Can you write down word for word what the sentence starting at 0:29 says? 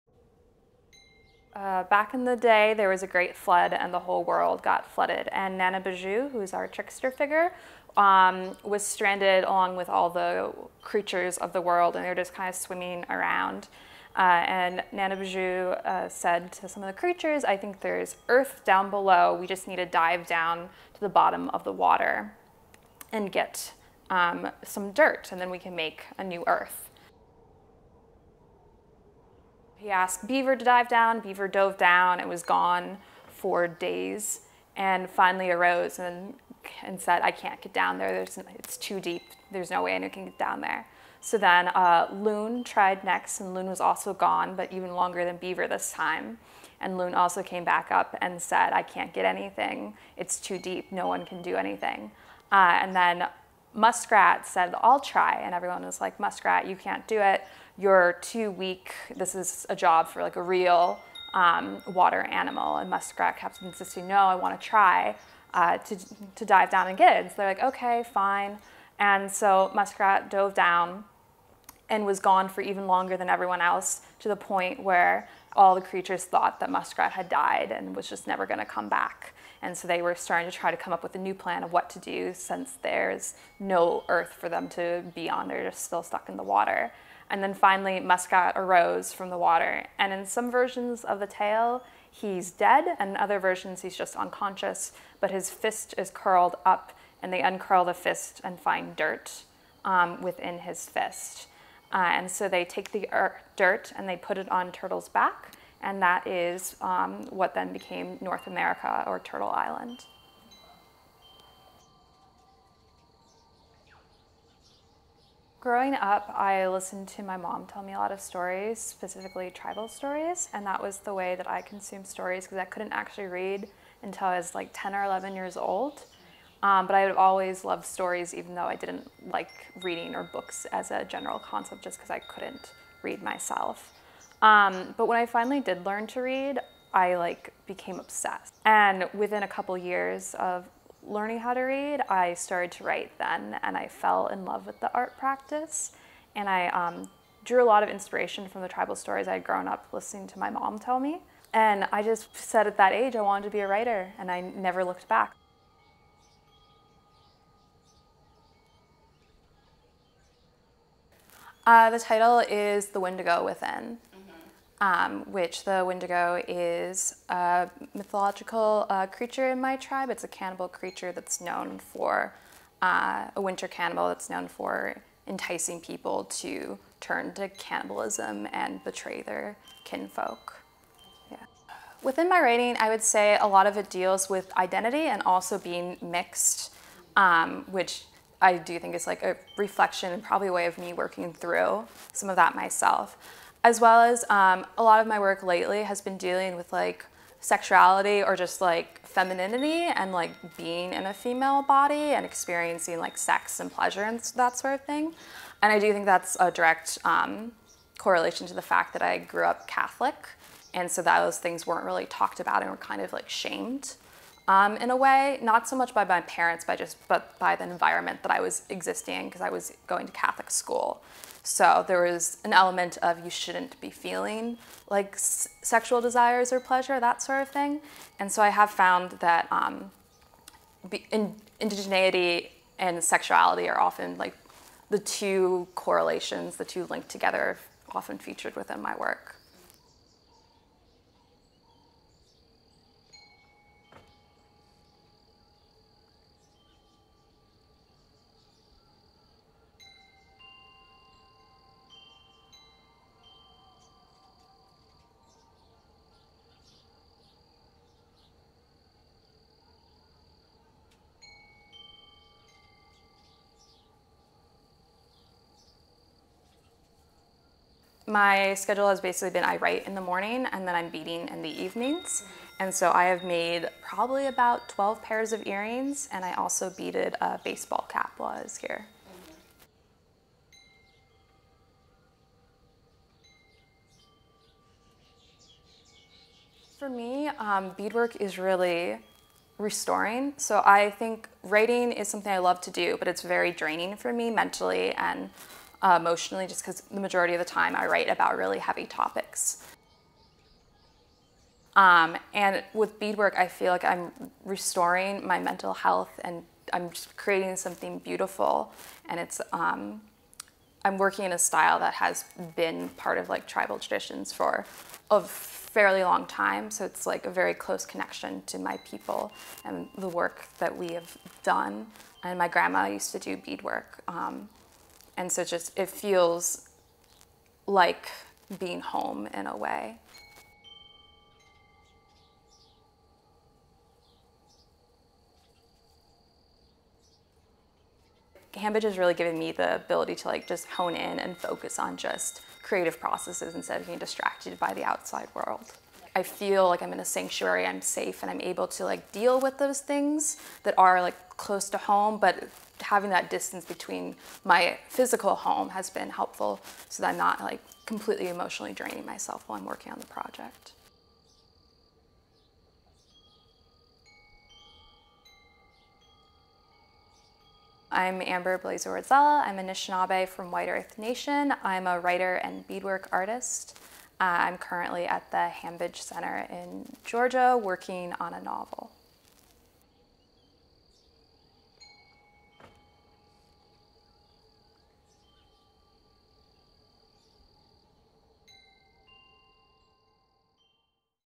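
He asked Beaver to dive down.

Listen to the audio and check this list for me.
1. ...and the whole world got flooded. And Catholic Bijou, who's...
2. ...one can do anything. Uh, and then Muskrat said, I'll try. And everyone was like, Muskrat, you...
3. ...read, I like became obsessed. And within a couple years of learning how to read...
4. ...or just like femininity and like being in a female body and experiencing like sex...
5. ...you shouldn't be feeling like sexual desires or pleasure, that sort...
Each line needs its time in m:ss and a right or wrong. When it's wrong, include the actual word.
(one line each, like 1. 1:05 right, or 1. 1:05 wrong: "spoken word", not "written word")
1. 0:03 wrong: "Nana", not "Catholic"
2. 0:51 right
3. 2:16 right
4. 3:18 right
5. 3:43 right.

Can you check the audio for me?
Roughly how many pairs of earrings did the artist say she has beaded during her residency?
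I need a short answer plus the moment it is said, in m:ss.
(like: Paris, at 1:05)
12, at 4:34.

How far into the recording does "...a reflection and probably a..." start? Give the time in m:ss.
3:09.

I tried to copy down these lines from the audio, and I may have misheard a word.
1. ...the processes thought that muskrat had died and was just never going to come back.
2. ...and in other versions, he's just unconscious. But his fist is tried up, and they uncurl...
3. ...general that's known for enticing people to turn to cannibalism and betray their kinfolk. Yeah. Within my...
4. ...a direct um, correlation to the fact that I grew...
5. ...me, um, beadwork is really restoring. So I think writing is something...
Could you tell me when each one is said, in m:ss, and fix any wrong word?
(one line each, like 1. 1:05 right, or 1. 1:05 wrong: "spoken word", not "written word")
1. 1:15 wrong: "creatures", not "processes"
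2. 1:32 wrong: "curled", not "tried"
3. 2:53 wrong: "cannibal", not "general"
4. 3:26 right
5. 4:46 right.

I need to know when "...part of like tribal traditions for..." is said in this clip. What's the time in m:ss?
5:12.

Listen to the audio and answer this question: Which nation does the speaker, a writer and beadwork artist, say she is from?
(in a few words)
White Earth Nation.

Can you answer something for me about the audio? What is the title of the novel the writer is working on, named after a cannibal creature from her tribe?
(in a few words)
The Wendigo Within.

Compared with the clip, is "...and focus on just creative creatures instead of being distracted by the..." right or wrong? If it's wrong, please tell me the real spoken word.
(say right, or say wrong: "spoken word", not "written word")
wrong: "processes", not "creatures".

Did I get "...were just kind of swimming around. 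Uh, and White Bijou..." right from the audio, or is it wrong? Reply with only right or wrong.
wrong.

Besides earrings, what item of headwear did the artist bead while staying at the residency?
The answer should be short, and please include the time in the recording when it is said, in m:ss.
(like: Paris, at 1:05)
baseball cap, at 4:37.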